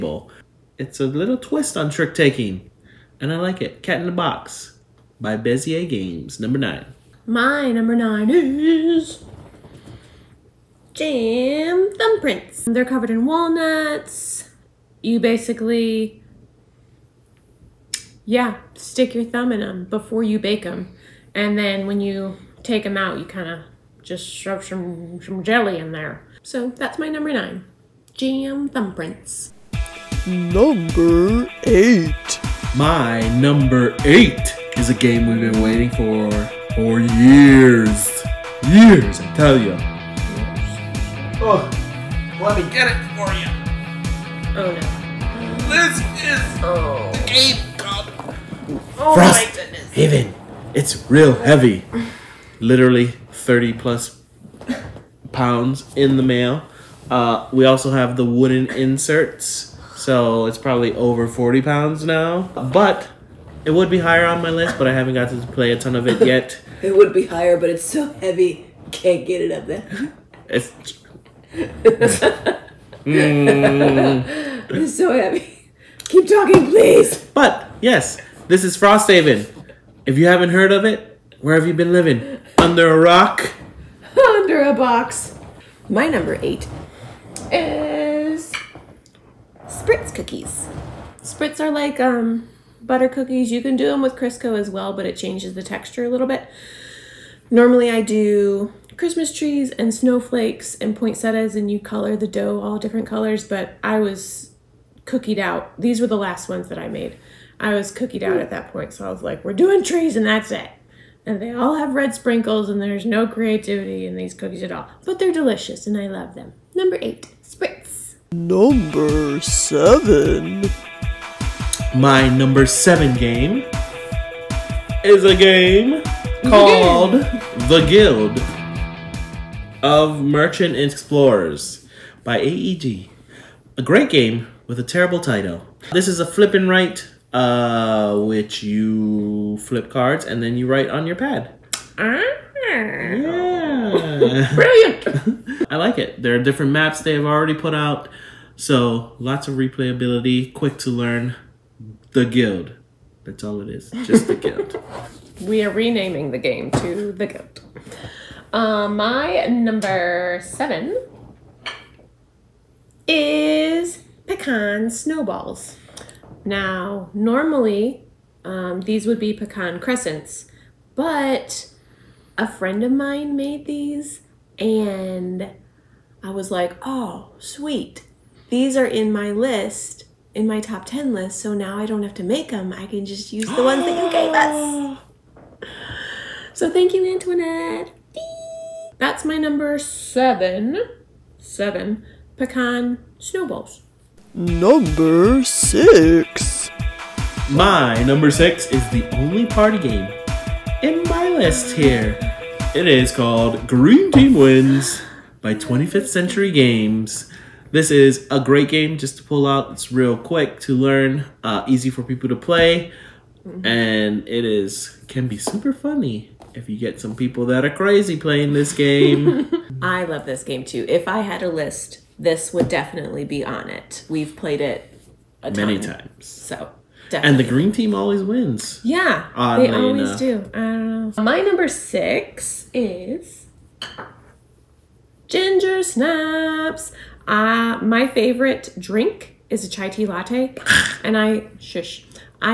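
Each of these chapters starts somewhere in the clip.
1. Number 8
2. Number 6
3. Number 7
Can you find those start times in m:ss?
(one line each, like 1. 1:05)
1. 0:29
2. 3:14
3. 1:58.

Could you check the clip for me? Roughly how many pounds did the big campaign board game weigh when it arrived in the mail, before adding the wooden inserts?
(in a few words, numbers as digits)
30 plus.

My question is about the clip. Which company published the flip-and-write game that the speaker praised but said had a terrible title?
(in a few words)
AEG.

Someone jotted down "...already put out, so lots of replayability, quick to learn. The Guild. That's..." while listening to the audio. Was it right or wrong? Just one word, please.
right.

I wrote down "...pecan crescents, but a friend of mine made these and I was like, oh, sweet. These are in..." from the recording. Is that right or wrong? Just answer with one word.
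right.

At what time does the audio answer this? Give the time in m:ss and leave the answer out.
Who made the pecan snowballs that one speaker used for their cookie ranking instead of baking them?
3:07.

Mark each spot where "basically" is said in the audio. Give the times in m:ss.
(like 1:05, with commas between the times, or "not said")
0:15.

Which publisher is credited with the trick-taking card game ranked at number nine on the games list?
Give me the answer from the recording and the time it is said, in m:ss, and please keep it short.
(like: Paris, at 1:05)
Bezier Games, at 0:05.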